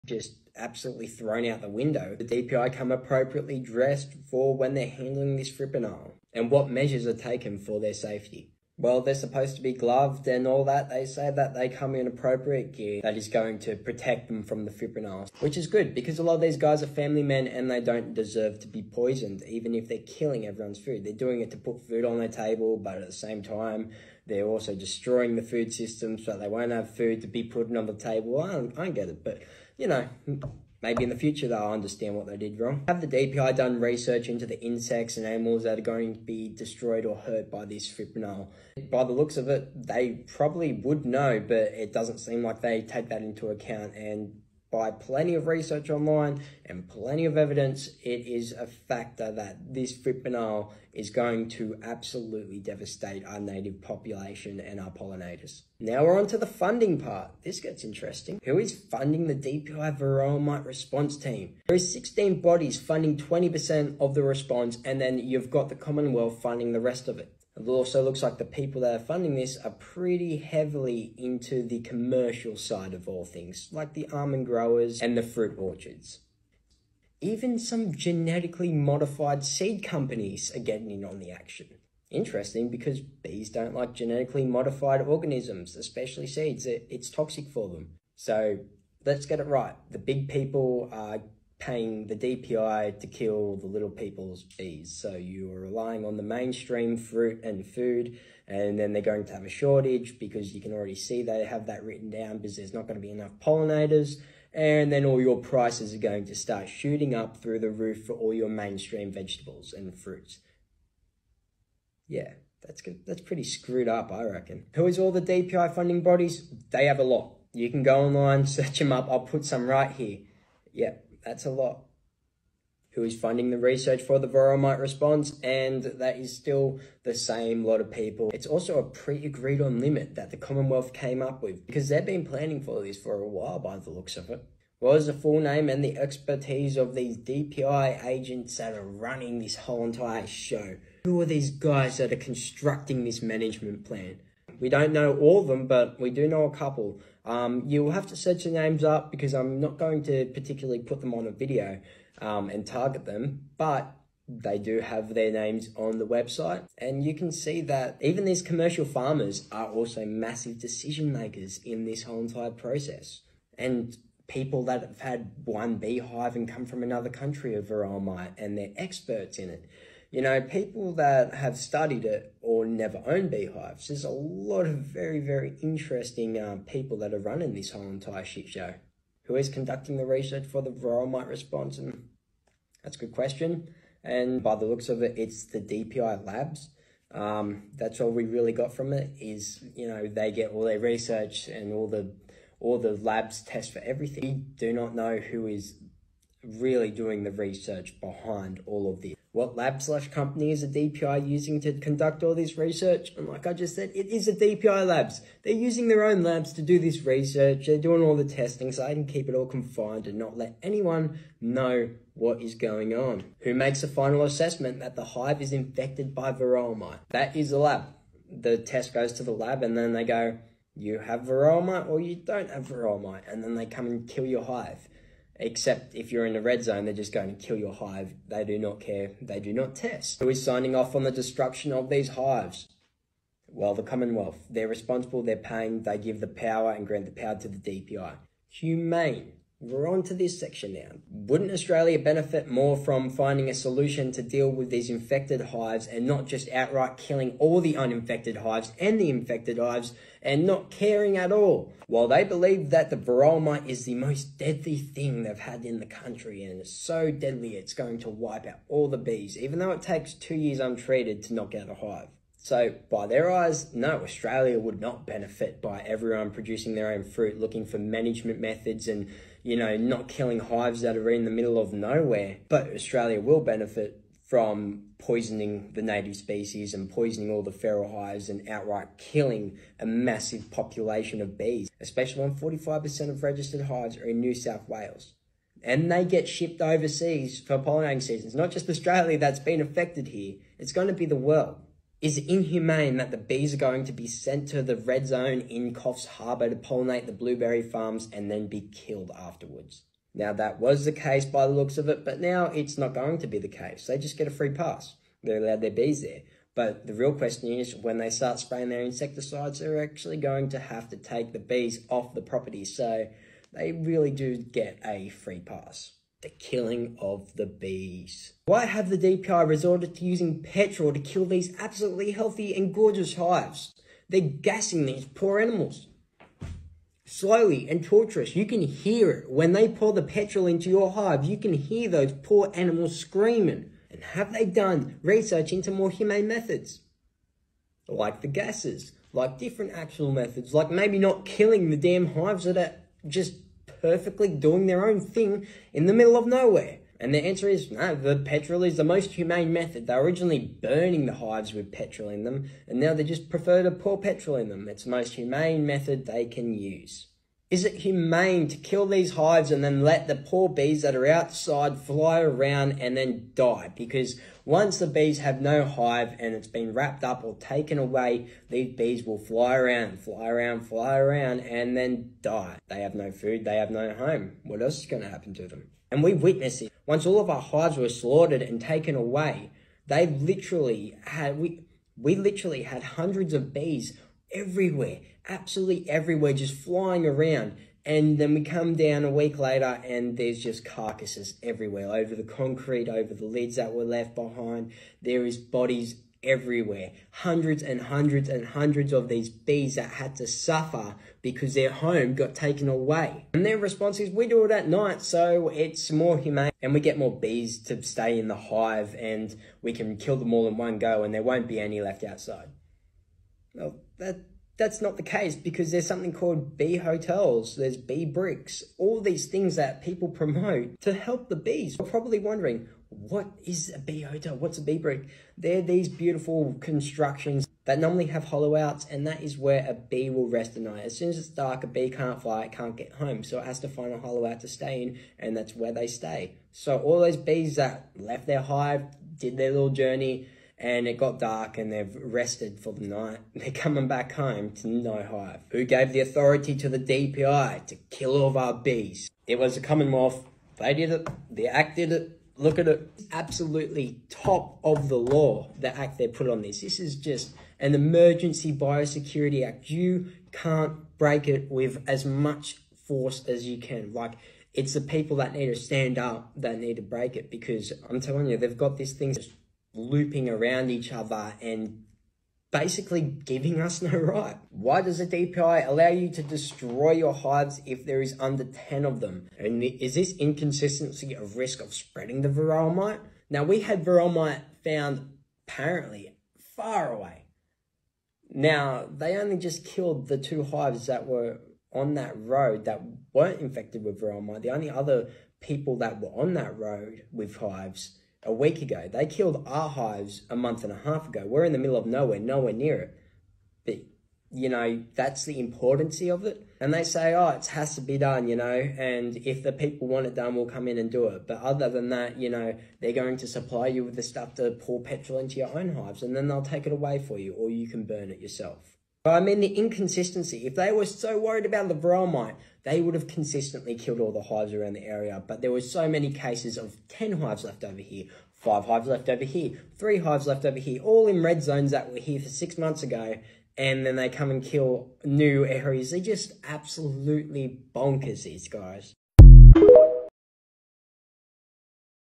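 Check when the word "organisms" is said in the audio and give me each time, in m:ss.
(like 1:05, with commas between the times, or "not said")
1:25.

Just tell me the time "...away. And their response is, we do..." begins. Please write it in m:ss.
6:42.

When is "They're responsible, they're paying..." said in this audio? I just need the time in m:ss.
3:54.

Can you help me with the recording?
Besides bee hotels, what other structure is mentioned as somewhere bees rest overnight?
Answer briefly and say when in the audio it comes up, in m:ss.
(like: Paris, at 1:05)
bee bricks, at 6:57.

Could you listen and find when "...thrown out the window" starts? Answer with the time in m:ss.
0:01.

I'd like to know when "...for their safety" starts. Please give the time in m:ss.
0:07.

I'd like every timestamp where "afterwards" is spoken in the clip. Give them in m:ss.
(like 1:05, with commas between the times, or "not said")
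4:59.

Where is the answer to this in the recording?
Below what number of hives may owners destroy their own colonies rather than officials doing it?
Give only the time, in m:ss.
7:58.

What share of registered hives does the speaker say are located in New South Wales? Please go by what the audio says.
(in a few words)
45%.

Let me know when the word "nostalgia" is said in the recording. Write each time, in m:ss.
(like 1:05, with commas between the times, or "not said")
not said.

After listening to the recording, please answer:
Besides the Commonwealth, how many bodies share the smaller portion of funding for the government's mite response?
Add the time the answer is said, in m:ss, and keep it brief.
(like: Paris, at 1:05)
16, at 1:01.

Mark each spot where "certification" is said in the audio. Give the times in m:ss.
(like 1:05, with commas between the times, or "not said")
not said.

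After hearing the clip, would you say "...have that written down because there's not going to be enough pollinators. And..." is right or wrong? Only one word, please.
right.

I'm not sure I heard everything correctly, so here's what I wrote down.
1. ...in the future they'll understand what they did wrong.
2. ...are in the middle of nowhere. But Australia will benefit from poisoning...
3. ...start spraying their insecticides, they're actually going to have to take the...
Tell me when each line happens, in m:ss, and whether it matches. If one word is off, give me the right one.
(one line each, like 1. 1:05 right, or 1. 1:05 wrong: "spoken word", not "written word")
1. 0:31 right
2. 4:30 right
3. 5:08 right.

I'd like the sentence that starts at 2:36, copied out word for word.
And you can see that even these commercial farmers are also massive decision makers in this whole entire process.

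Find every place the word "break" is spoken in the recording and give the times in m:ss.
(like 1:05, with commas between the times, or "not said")
7:40, 7:46.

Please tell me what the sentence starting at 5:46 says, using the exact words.
And the answer is no, the petrol is the most humane method.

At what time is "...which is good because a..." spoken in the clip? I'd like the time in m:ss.
0:15.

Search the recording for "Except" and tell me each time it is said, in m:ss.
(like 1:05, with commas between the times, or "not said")
3:45.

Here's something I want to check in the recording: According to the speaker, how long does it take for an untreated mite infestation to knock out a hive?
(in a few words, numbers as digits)
2 years.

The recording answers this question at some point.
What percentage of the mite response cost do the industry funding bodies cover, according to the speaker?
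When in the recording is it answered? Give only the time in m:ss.
1:03.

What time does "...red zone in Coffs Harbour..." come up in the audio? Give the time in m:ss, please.
4:54.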